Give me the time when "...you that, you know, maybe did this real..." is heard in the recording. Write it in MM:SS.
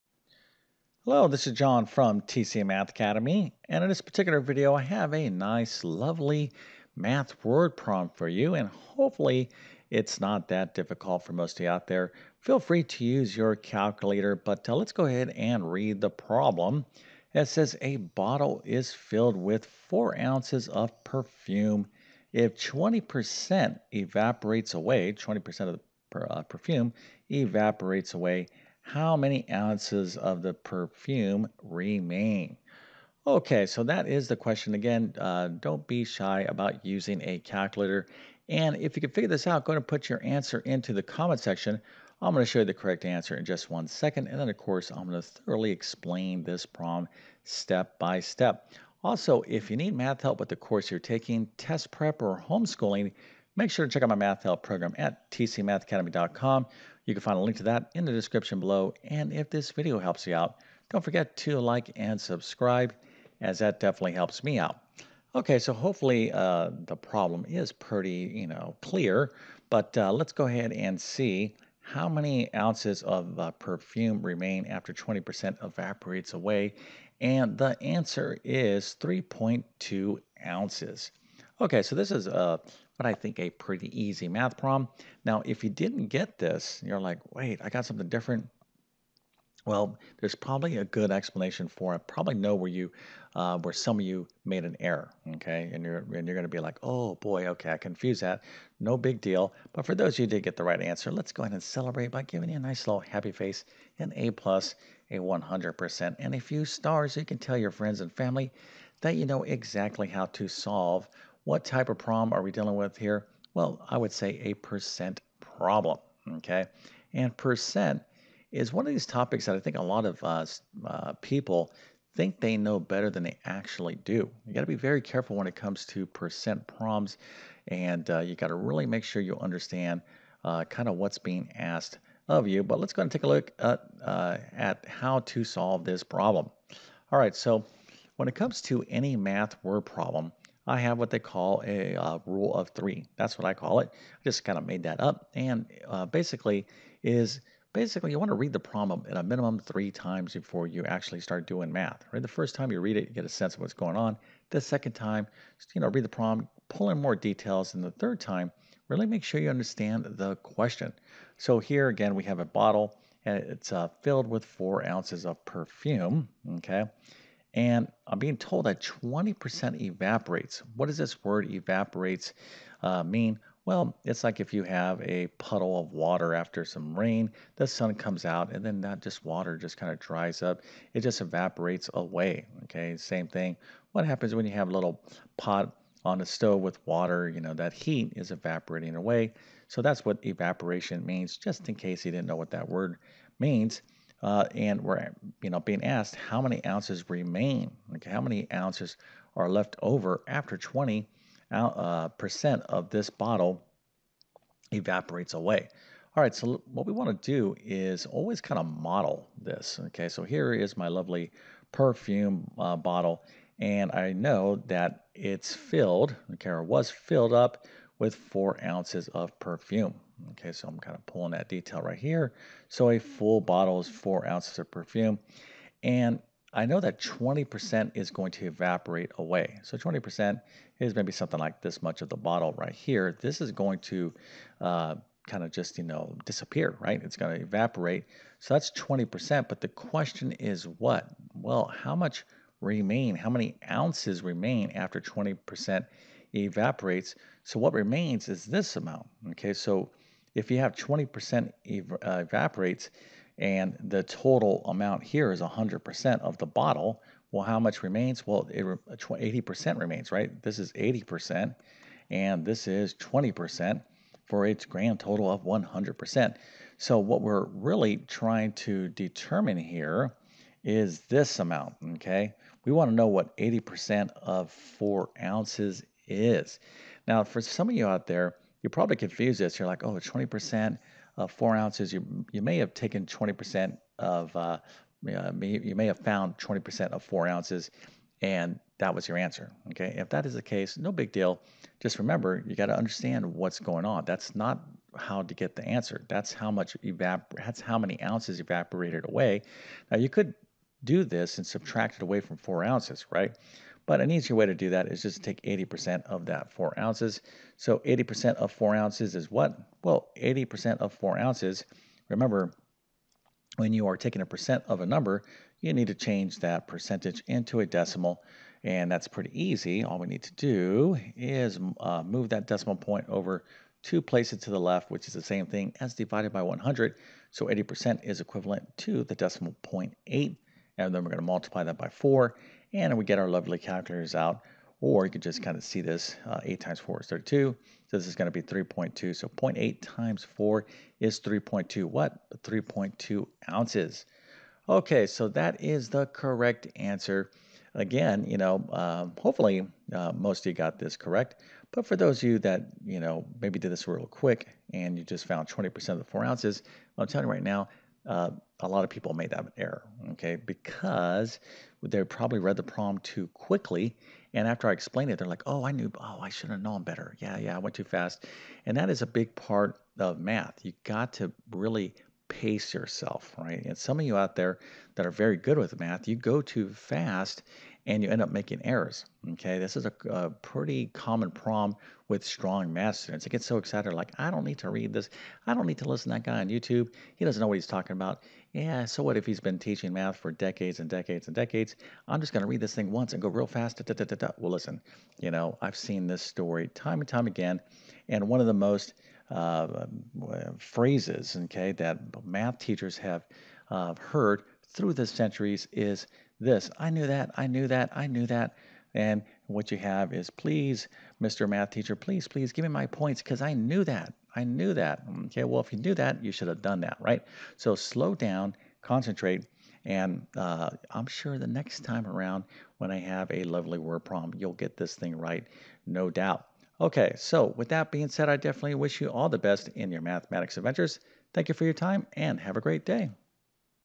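05:52.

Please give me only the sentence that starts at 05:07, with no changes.
So 80% of four ounces is what?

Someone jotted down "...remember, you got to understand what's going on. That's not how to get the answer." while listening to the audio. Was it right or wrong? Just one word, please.
right.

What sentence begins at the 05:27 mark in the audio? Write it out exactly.
So 80% is equivalent to the decimal point 8.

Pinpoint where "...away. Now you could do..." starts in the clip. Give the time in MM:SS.
04:59.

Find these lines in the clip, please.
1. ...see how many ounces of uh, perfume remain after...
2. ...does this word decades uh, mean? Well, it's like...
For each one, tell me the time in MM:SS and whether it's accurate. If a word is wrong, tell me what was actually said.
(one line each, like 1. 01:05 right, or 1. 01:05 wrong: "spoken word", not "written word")
1. 01:10 right
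2. 02:50 wrong: "evaporates", not "decades".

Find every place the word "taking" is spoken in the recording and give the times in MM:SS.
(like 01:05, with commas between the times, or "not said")
00:50, 05:13.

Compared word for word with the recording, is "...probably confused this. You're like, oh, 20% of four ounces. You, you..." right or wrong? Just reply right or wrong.
right.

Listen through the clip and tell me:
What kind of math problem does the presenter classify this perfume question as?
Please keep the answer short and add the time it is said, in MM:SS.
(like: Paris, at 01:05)
a percent problem, at 01:54.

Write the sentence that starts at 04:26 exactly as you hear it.
So what we're really trying to determine here is this amount, okay?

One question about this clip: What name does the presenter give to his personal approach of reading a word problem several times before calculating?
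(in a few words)
rule of three.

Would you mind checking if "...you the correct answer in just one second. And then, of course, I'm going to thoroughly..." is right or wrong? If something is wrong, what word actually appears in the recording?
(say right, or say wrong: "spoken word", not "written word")
right.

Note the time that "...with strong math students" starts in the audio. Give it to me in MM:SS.
06:22.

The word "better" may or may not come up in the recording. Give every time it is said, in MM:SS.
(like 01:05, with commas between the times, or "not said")
02:02, 06:06.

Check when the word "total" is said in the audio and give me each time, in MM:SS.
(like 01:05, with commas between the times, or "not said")
04:14, 04:24.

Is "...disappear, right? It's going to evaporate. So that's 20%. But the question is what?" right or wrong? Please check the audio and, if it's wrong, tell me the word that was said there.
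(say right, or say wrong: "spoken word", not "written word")
right.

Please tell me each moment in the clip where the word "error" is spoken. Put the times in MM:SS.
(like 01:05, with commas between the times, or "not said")
01:34, 05:59, 06:18.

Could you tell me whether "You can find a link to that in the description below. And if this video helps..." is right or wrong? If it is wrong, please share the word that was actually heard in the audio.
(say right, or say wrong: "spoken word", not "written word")
right.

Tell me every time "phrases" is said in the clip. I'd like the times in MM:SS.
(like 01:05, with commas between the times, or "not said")
06:40.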